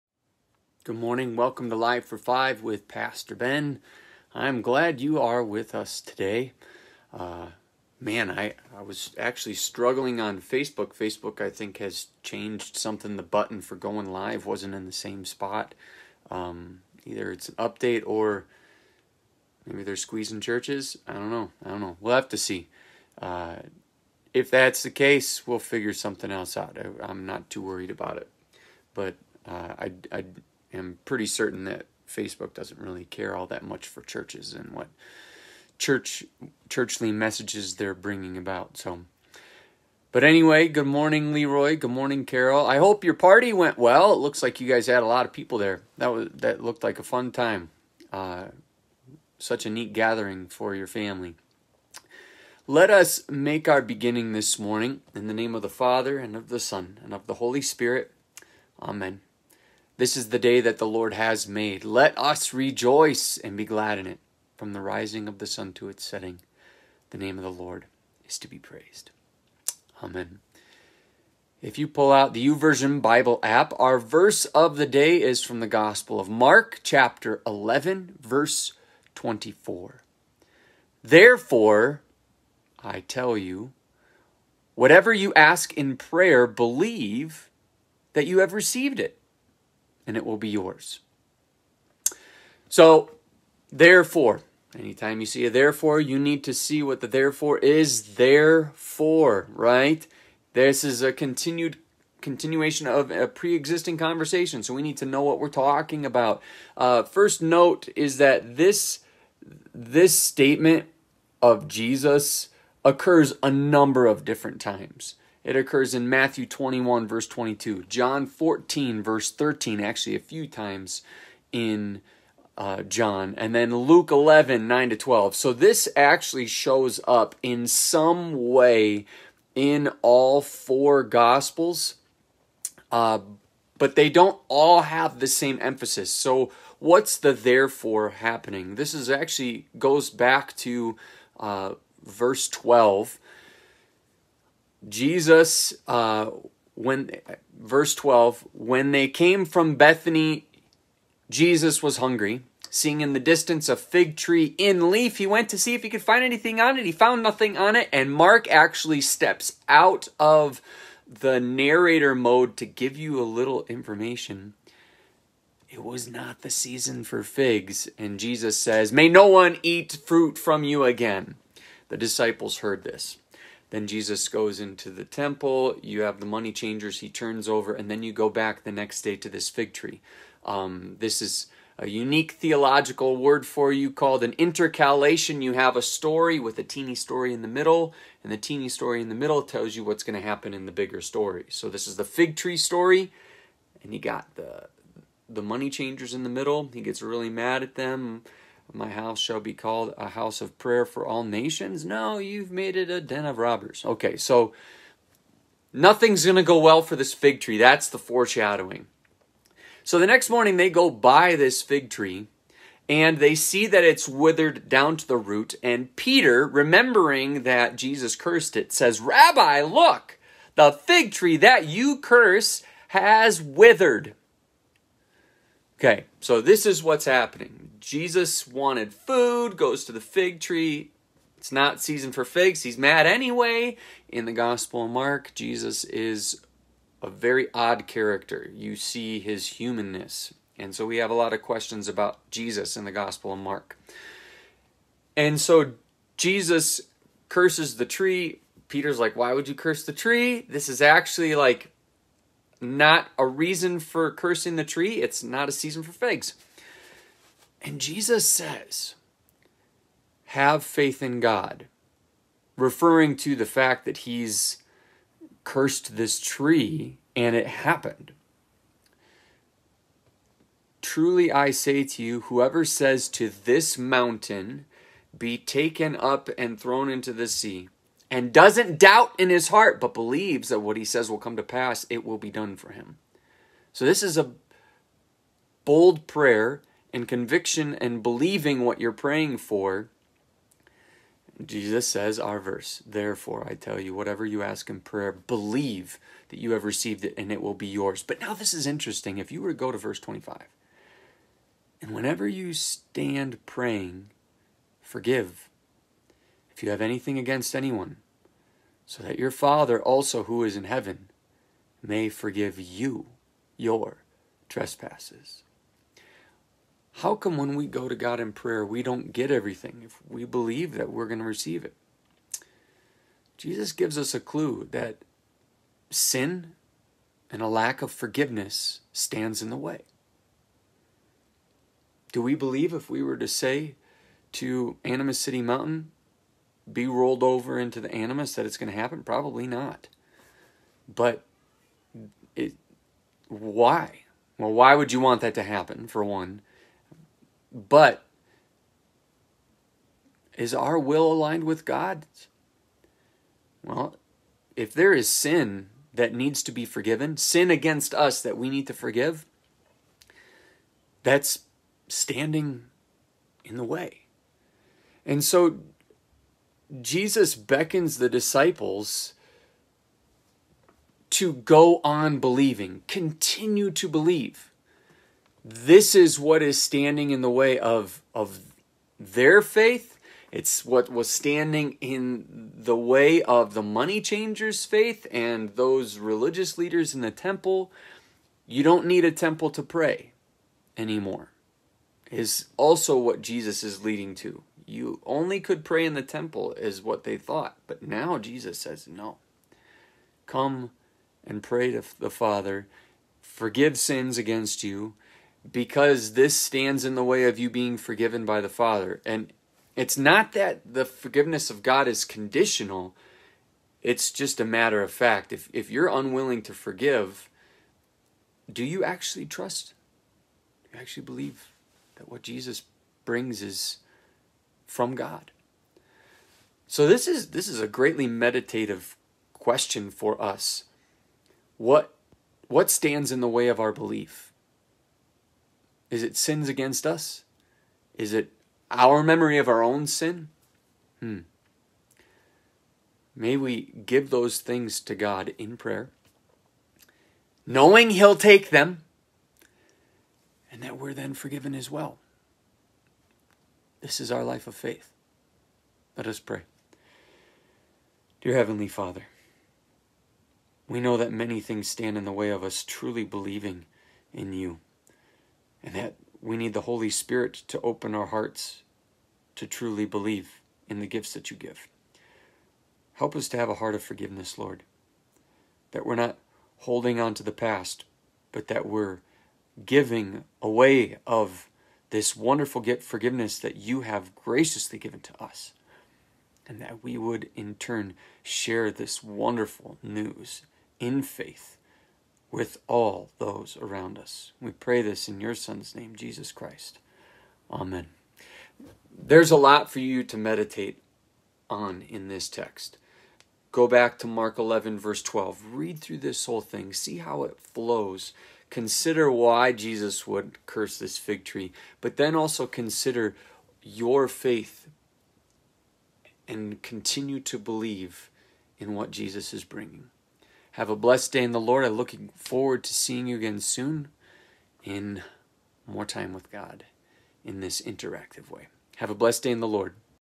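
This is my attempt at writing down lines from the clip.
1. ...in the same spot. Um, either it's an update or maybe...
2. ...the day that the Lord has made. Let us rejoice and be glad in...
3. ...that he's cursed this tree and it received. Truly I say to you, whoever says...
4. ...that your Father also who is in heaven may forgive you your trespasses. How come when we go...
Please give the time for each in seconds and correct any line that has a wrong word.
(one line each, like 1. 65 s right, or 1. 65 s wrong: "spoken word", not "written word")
1. 14 s right
2. 60 s right
3. 263 s wrong: "happened", not "received"
4. 309 s right.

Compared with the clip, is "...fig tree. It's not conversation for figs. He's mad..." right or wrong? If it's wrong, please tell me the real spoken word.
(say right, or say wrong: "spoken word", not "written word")
wrong: "season", not "conversation".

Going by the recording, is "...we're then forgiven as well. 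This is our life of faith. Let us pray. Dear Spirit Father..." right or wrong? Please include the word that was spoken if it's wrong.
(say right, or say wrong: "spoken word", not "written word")
wrong: "Heavenly", not "Spirit".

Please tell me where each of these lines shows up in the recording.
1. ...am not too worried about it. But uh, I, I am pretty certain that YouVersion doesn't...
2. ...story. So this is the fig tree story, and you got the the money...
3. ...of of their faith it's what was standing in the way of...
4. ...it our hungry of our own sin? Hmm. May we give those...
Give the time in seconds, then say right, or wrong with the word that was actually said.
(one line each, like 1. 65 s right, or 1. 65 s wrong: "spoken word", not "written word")
1. 27 s wrong: "Facebook", not "YouVersion"
2. 190 s right
3. 377 s right
4. 438 s wrong: "memory", not "hungry".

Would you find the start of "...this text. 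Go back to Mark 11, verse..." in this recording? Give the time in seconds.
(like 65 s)
502 s.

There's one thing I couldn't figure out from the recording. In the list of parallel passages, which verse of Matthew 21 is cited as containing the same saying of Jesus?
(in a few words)
22.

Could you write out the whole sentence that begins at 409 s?
And it's not that the forgiveness of God is conditional, it's just a matter of fact.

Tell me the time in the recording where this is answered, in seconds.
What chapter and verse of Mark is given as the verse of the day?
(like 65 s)
76 s.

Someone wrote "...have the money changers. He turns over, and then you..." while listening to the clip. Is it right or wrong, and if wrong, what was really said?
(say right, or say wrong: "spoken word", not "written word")
right.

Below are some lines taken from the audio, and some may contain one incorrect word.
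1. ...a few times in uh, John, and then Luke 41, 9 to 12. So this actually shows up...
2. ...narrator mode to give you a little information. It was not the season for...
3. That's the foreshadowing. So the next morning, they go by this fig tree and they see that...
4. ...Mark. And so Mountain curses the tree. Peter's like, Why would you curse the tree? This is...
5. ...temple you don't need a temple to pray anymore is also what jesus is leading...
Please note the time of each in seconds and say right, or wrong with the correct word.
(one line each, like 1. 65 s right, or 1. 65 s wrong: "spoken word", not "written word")
1. 120 s wrong: "11", not "41"
2. 161 s right
3. 207 s right
4. 243 s wrong: "Jesus", not "Mountain"
5. 387 s right.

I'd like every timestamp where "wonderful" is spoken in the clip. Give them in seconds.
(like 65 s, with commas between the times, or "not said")
482 s, 489 s.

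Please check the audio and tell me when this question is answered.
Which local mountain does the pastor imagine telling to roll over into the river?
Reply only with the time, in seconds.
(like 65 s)
334 s.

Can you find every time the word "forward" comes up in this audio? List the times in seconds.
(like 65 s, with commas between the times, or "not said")
522 s.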